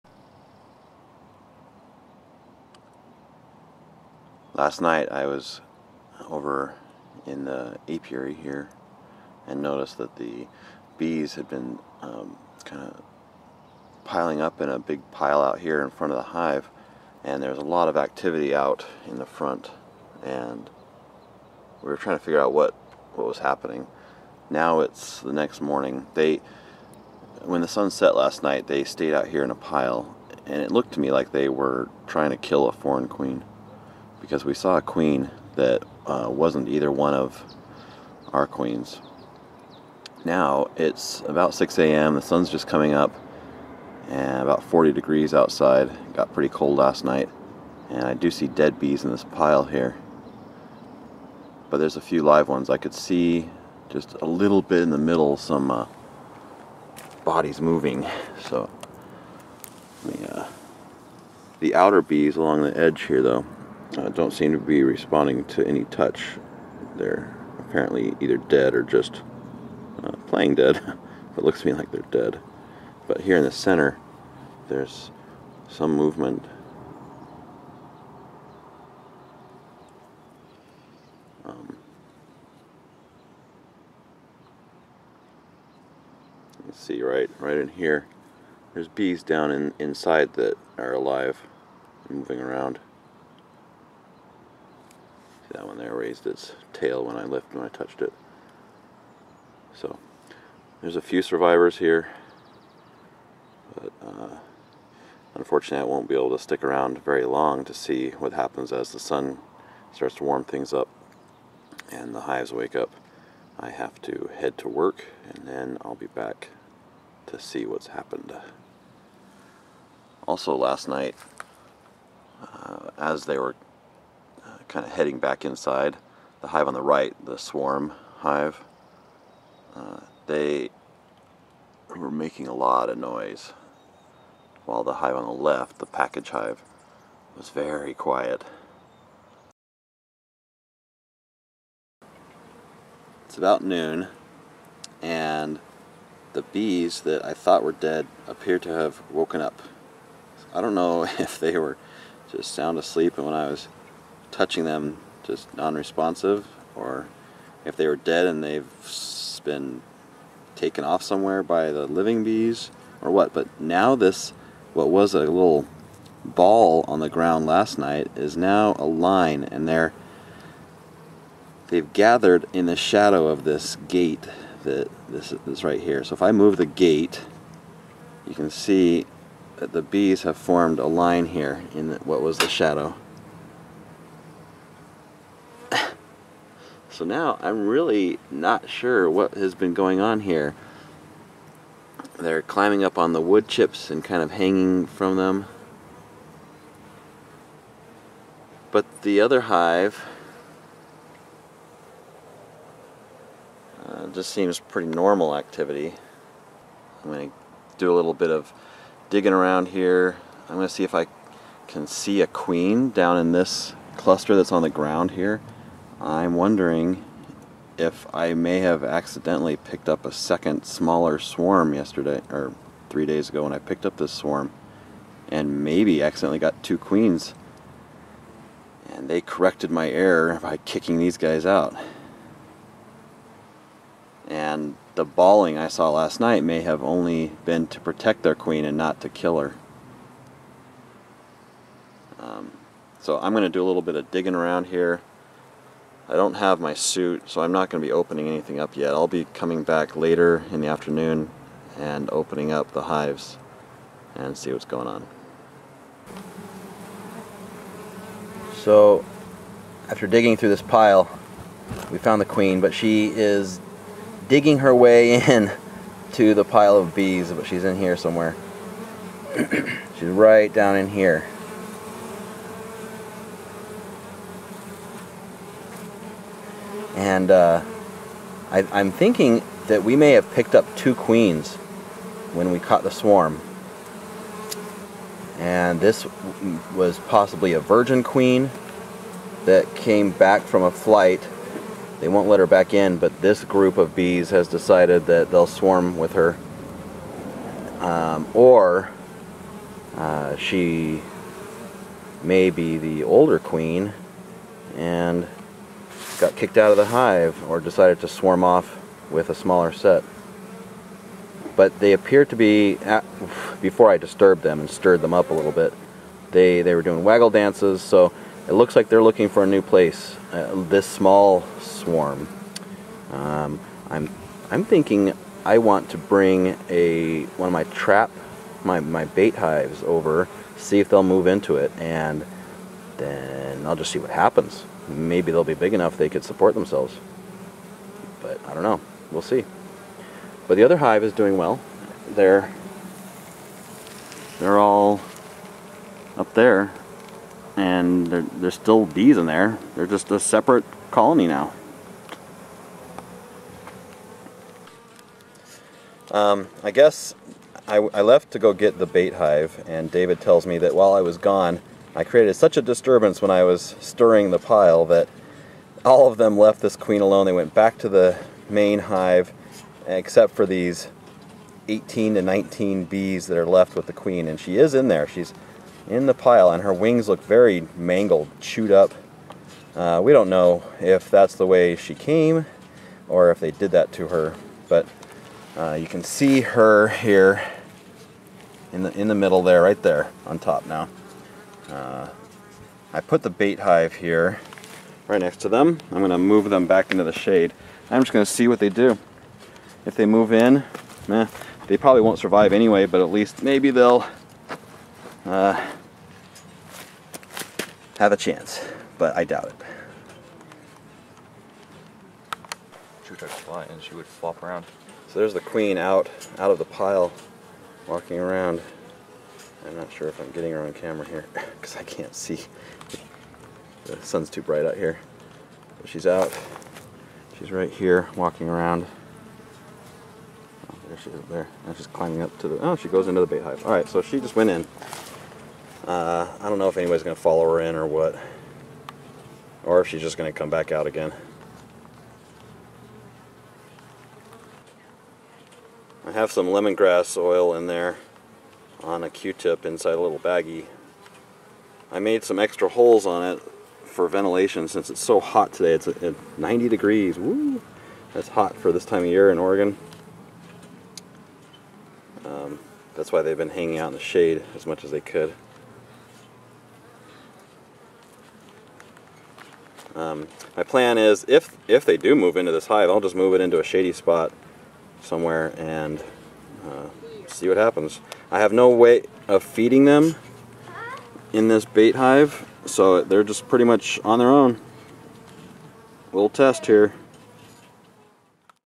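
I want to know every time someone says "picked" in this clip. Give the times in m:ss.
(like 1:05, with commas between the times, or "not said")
3:39, 3:43, 4:40.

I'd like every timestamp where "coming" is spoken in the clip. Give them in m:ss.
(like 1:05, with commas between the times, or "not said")
0:42, 4:09.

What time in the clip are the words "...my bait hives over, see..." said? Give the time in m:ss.
5:28.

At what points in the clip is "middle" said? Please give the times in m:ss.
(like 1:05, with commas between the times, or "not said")
0:54, 6:29.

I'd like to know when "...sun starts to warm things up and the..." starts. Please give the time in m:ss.
1:48.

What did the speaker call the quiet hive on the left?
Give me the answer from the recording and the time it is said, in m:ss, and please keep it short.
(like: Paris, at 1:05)
the package hive, at 2:15.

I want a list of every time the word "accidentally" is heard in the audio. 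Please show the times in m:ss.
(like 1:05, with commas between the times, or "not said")
3:38, 3:46.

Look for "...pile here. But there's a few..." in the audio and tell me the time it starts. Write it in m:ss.
0:49.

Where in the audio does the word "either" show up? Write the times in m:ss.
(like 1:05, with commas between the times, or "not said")
0:36, 1:08.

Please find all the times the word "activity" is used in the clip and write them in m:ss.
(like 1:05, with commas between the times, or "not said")
0:17, 3:25.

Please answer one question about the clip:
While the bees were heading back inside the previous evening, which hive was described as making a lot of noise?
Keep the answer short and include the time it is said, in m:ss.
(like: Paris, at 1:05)
the swarm hive, at 2:07.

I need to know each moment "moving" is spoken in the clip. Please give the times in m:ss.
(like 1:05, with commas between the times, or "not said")
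0:57, 1:32.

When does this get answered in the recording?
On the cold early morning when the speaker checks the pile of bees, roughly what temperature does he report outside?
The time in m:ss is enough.
0:44.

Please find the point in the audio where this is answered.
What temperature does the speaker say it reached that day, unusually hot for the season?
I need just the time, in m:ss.
7:36.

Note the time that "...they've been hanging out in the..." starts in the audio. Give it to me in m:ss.
7:43.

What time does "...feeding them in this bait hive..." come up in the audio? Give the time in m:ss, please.
7:59.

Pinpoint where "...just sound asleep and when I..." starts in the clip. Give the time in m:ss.
2:32.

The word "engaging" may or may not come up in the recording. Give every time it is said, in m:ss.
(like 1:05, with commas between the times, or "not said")
not said.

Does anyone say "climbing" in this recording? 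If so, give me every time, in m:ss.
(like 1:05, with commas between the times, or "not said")
3:12, 7:11.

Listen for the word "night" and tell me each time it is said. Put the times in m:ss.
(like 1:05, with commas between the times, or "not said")
0:04, 0:28, 0:47, 2:00, 2:47, 3:56.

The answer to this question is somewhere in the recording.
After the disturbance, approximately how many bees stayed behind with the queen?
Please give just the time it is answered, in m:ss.
6:11.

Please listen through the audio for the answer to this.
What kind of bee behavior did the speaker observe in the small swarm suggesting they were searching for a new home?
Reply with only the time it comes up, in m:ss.
5:17.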